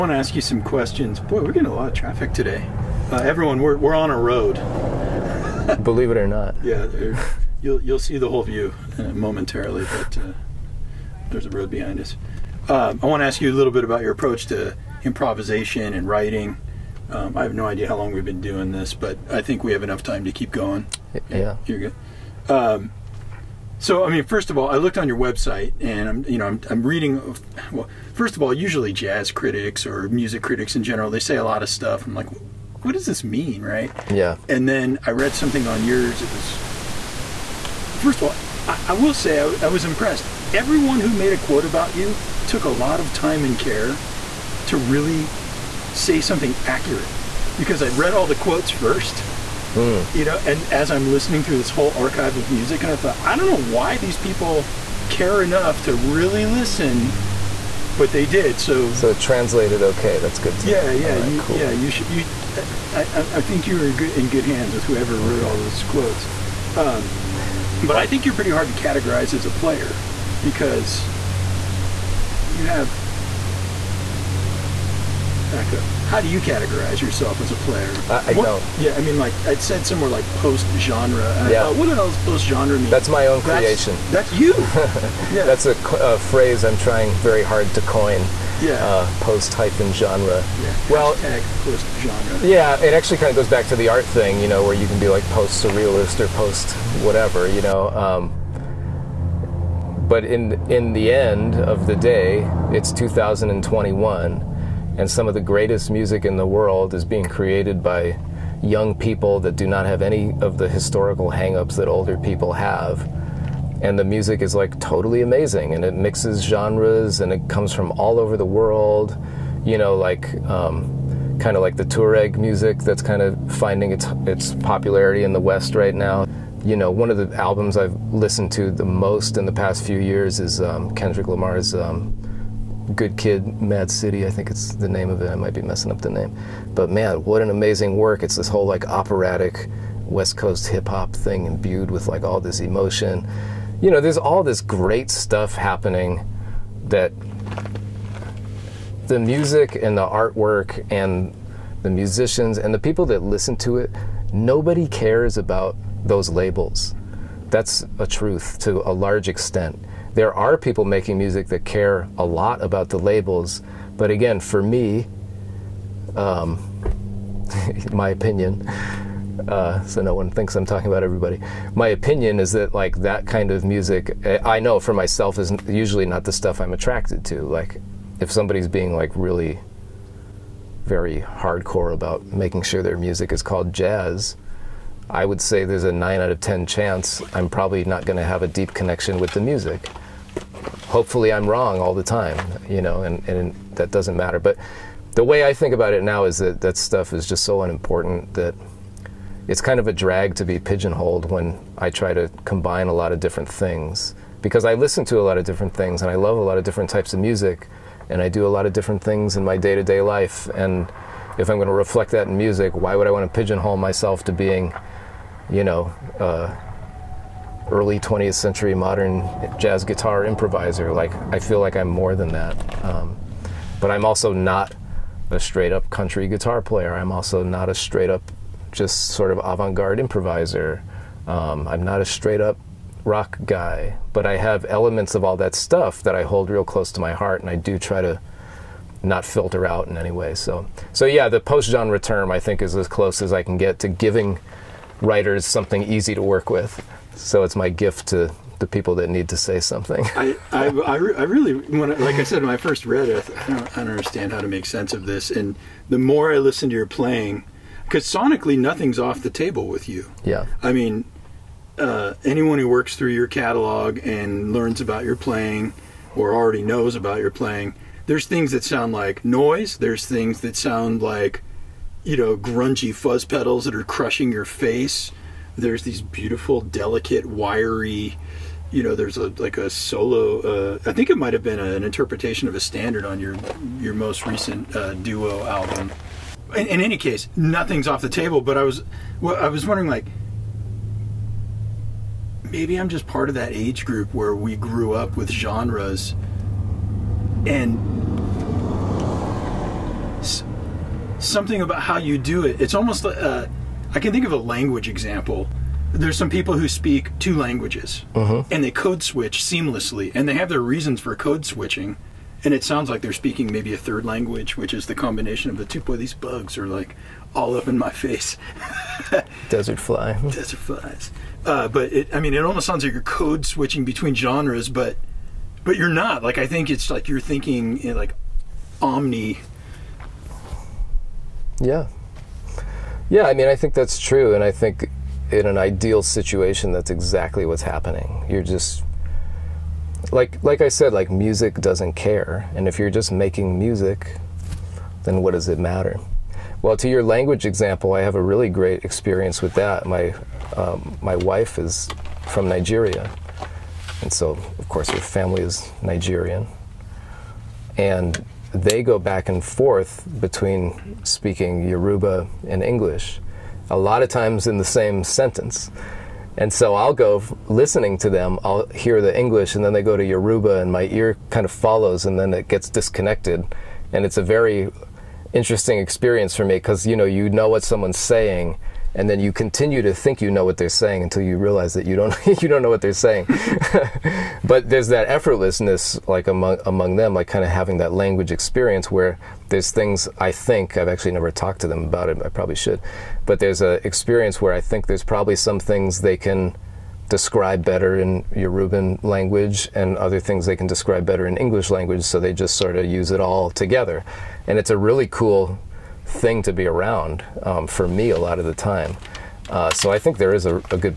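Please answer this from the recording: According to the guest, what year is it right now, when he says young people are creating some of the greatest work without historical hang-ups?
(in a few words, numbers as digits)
2021.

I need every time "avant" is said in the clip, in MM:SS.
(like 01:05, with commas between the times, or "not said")
03:49.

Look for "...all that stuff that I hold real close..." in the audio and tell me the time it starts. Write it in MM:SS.
03:55.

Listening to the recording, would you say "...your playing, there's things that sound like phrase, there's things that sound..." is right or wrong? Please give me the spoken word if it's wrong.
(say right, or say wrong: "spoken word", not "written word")
wrong: "noise", not "phrase".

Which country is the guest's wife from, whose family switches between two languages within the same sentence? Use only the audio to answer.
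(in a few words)
Nigeria.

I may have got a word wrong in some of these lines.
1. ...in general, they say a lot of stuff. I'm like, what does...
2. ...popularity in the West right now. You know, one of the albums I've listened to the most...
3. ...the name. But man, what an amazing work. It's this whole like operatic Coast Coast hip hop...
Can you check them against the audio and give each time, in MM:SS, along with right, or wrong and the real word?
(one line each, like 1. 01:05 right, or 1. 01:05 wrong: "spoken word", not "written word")
1. 00:30 right
2. 02:04 right
3. 02:16 wrong: "West", not "Coast".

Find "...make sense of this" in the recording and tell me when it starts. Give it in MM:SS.
04:14.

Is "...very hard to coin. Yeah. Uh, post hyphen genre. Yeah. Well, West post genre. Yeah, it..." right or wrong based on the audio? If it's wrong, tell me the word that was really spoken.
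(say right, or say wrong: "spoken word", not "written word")
wrong: "Hashtag", not "West".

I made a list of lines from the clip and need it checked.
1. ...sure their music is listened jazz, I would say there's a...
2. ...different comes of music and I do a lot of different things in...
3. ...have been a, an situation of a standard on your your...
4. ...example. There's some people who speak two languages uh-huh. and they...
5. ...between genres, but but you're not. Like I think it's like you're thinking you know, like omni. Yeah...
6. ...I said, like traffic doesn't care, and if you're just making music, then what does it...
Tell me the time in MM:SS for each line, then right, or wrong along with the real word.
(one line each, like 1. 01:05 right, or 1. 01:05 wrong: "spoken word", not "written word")
1. 03:02 wrong: "called", not "listened"
2. 03:26 wrong: "types", not "comes"
3. 04:41 wrong: "interpretation", not "situation"
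4. 05:04 right
5. 05:23 right
6. 05:40 wrong: "music", not "traffic".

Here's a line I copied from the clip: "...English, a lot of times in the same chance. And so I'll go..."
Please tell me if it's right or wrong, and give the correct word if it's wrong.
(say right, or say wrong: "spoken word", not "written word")
wrong: "sentence", not "chance".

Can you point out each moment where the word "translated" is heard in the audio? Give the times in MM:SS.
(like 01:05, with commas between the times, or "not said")
00:59.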